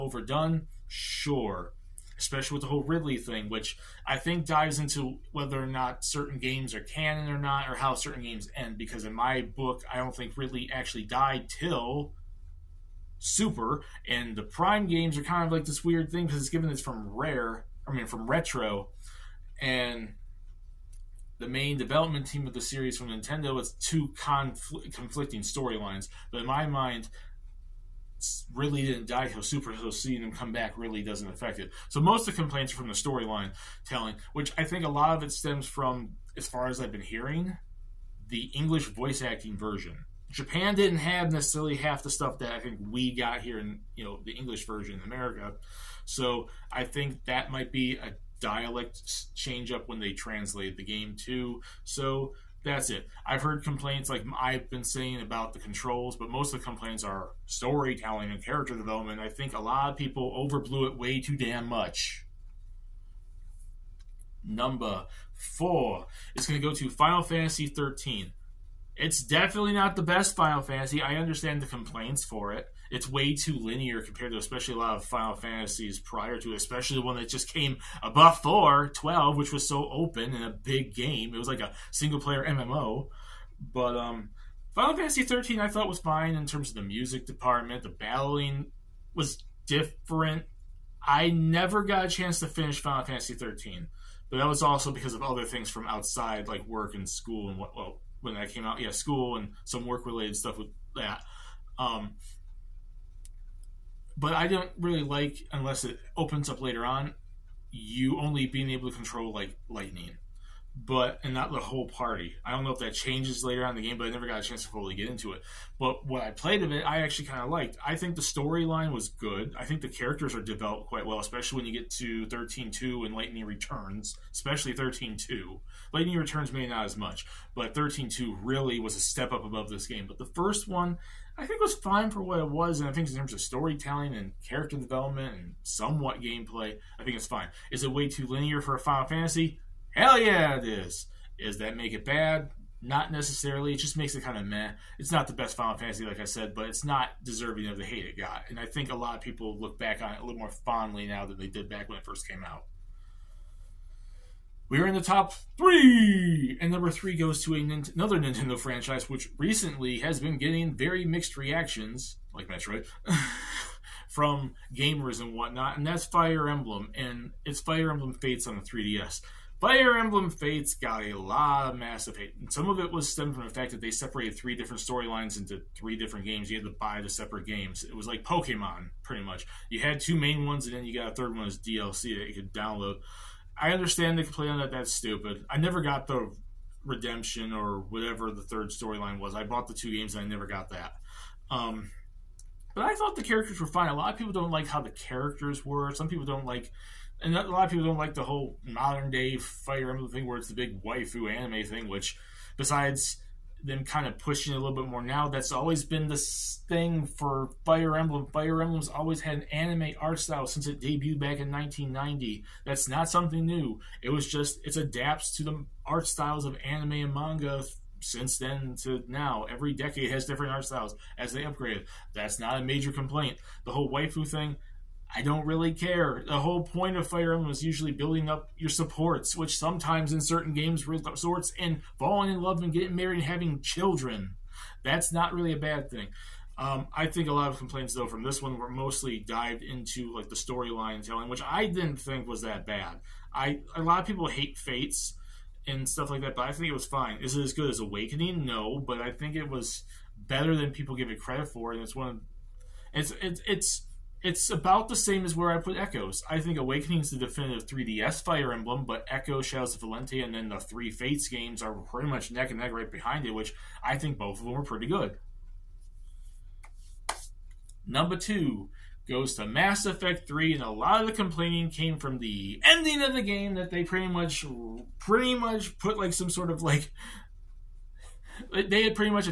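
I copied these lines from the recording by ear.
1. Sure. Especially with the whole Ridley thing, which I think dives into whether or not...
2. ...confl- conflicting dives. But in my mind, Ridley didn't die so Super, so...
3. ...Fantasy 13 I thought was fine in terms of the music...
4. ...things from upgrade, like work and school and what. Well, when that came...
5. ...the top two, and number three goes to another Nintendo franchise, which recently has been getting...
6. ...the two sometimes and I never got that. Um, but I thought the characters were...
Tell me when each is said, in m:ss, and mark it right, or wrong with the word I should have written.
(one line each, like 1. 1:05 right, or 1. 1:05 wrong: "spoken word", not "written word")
1. 0:00 right
2. 0:24 wrong: "storylines", not "dives"
3. 1:24 right
4. 1:35 wrong: "outside", not "upgrade"
5. 2:34 wrong: "three", not "two"
6. 3:09 wrong: "games", not "sometimes".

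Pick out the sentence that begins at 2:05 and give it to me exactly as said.
Lightning Returns may not as much, but thirteen two really was a step up above this game.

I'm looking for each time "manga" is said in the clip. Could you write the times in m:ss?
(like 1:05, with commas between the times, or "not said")
3:37.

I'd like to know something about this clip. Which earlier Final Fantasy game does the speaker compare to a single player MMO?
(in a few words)
12.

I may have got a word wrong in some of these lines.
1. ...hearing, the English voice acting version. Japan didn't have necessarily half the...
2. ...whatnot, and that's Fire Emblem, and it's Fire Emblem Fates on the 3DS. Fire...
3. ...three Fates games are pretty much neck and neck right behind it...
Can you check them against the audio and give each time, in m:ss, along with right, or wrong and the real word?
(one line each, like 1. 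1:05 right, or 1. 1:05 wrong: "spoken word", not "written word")
1. 0:37 right
2. 2:45 right
3. 4:20 right.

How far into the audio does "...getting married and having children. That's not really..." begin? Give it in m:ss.
3:52.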